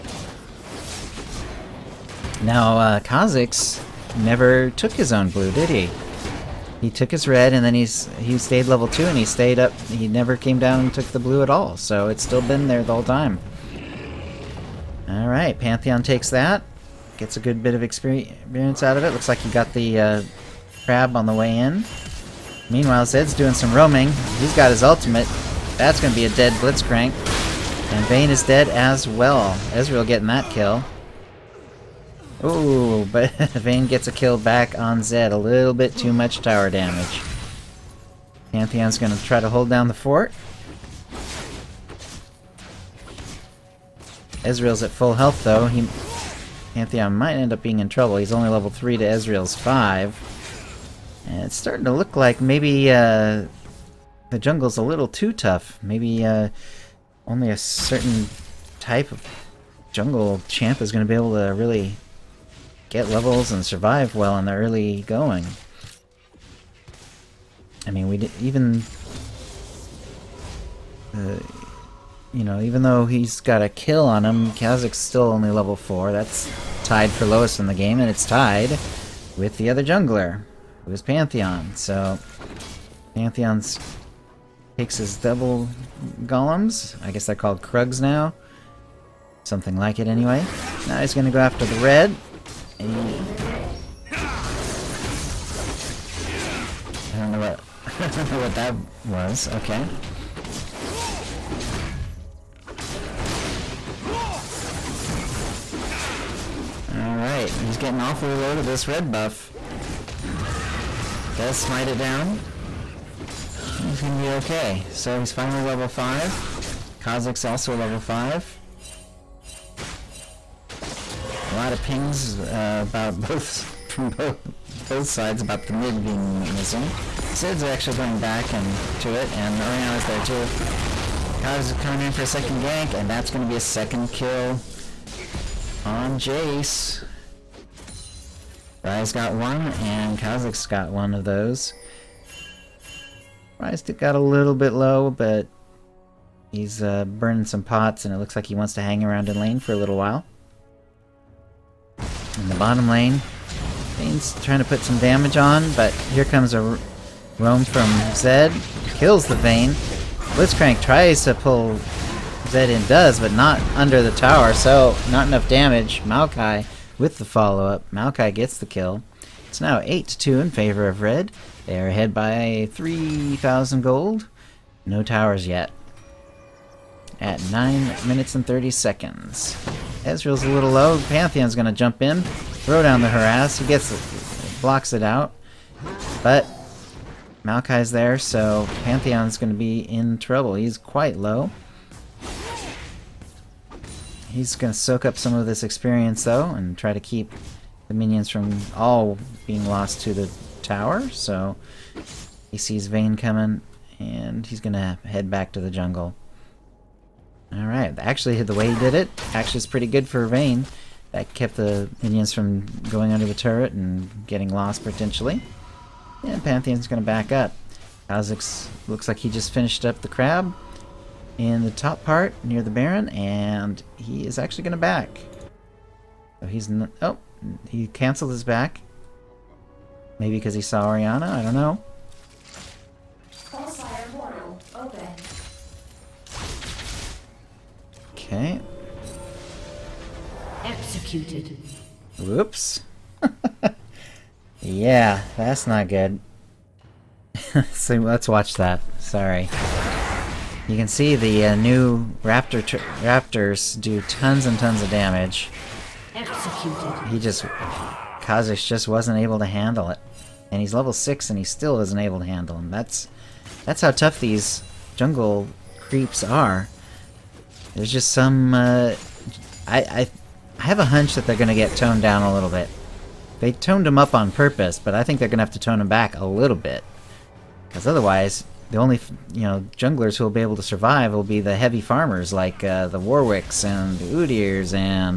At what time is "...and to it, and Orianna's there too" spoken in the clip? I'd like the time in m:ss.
2:08.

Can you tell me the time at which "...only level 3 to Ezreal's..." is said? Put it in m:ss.
0:48.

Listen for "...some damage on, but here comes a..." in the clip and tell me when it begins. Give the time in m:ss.
2:34.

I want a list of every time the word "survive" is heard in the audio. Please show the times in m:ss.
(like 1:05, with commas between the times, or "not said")
1:03, 4:40.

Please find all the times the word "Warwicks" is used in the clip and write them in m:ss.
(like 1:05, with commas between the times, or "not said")
4:42.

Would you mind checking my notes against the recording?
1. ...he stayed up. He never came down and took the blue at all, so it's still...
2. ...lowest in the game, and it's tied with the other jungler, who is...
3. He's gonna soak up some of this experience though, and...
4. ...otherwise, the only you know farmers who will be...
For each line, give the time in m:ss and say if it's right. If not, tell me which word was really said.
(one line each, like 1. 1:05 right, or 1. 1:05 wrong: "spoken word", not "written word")
1. 0:09 right
2. 1:17 right
3. 3:14 right
4. 4:37 wrong: "junglers", not "farmers".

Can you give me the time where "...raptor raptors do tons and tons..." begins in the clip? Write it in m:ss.
4:12.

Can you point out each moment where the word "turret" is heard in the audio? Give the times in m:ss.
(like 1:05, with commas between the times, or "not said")
3:33.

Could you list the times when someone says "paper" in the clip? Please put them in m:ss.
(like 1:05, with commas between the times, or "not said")
not said.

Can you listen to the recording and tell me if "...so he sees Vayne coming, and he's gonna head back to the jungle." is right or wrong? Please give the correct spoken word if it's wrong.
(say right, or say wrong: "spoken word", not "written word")
right.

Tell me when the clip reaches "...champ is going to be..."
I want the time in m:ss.
1:00.